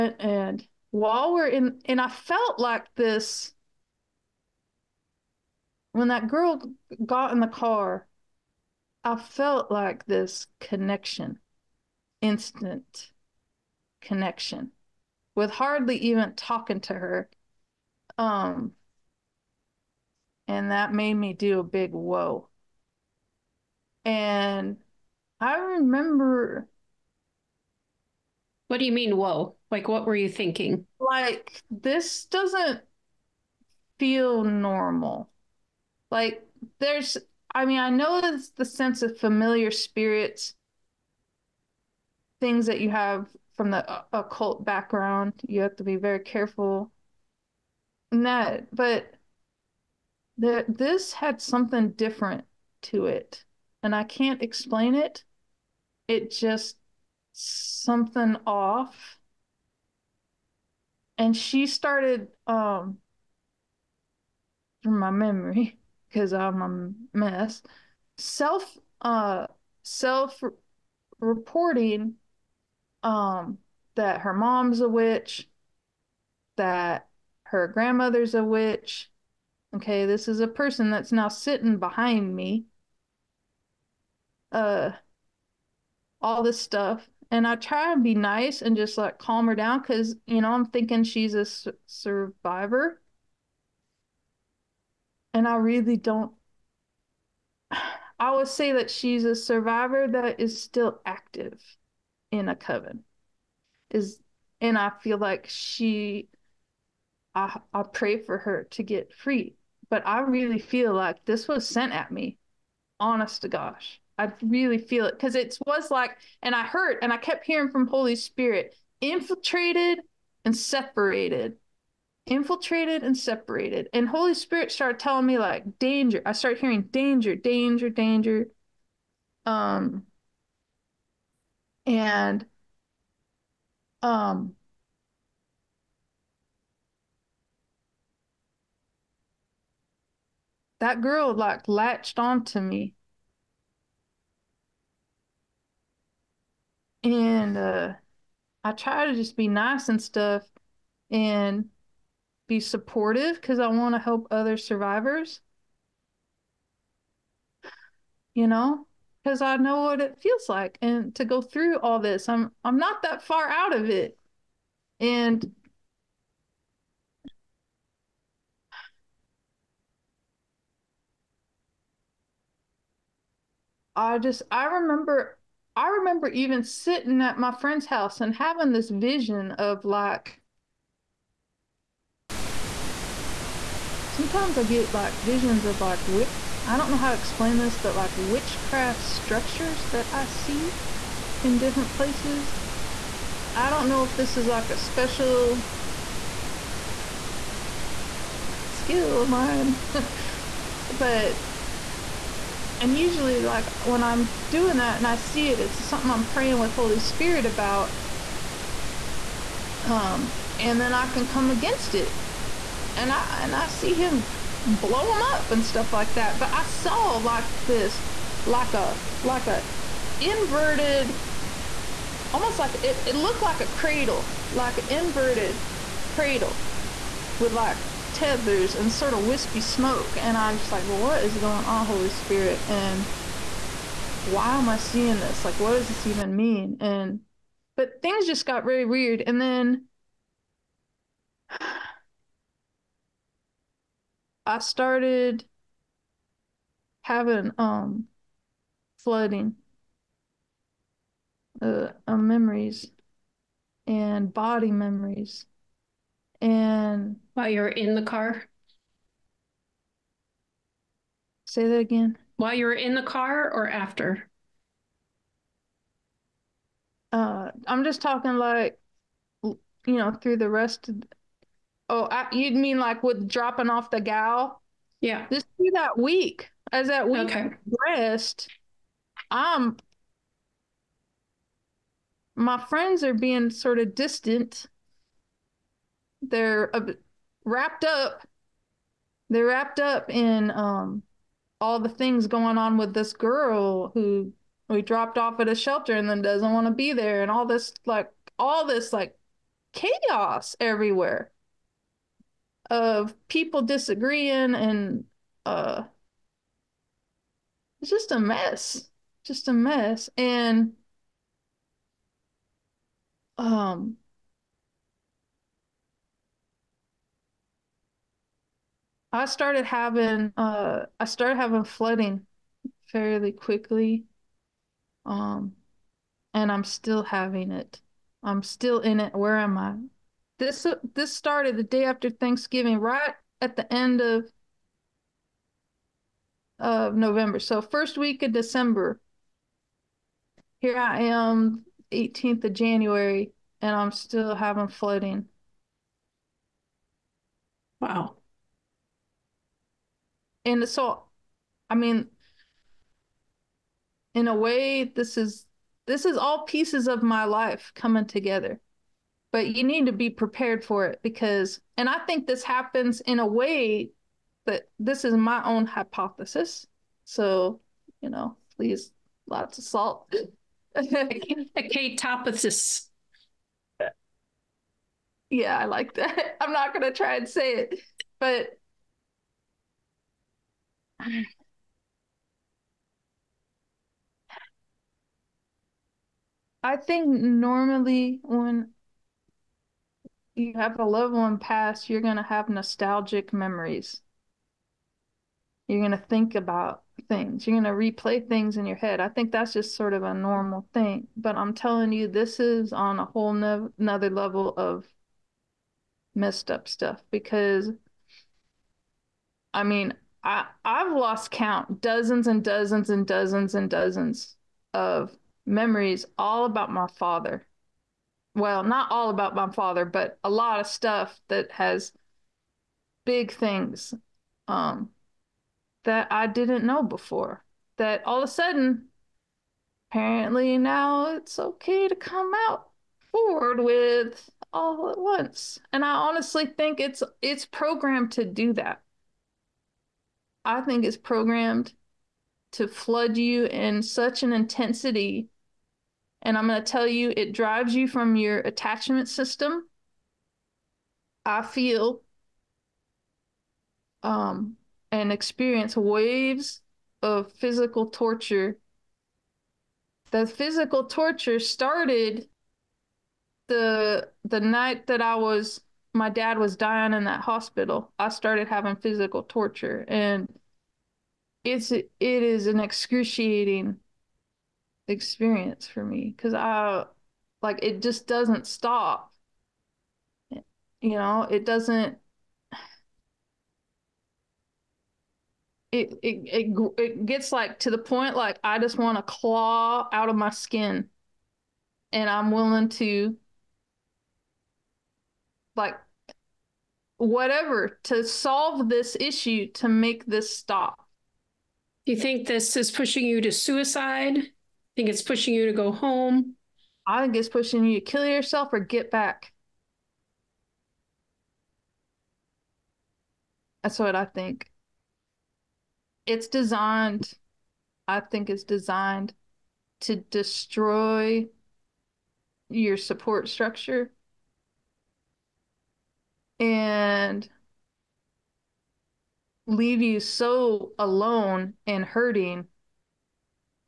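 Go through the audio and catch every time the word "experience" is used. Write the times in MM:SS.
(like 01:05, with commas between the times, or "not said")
07:35, 07:54.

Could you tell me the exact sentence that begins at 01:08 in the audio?
Self uh self reporting um that her mom's a witch that her grandmother's a witch.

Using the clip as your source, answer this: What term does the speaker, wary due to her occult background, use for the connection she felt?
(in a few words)
familiar spirits.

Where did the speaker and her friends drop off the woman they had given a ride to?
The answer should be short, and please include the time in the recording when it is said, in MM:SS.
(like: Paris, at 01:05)
a shelter, at 04:55.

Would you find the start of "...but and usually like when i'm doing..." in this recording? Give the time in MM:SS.
03:20.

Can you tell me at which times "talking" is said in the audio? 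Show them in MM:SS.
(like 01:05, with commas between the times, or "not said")
00:16, 04:28.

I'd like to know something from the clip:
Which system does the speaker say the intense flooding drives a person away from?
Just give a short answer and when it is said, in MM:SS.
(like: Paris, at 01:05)
attachment system, at 07:28.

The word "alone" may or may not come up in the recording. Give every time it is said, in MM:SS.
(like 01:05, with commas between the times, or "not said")
08:50.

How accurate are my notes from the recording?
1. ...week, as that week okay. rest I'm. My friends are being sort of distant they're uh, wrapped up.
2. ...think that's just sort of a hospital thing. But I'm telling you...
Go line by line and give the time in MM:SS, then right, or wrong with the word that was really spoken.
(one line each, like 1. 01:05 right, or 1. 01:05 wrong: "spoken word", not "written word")
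1. 04:35 right
2. 06:39 wrong: "normal", not "hospital".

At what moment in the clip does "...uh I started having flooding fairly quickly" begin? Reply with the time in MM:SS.
05:20.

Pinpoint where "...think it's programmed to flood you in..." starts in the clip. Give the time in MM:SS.
07:20.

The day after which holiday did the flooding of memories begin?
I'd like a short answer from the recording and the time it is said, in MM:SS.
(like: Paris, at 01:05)
Thanksgiving, at 05:32.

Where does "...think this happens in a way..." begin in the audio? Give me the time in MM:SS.
06:02.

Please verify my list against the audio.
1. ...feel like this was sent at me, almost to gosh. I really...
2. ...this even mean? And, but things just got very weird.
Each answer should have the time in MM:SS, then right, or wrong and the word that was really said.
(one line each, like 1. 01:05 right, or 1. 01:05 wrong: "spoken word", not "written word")
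1. 01:50 wrong: "honest", not "almost"
2. 03:55 right.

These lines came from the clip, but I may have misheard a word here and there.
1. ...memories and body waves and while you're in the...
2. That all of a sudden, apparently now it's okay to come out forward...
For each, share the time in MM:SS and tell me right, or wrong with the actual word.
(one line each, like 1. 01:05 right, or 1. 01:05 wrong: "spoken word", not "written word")
1. 04:12 wrong: "memories", not "waves"
2. 07:07 right.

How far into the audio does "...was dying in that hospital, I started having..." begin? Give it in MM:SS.
07:46.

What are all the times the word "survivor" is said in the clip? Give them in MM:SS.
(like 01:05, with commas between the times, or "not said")
01:31, 01:39, 02:34.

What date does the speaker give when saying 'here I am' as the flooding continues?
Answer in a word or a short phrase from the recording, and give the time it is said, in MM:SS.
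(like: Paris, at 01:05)
18 January, at 05:41.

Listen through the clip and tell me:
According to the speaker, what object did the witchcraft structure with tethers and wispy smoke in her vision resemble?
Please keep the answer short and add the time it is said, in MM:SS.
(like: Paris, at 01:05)
inverted cradle, at 03:44.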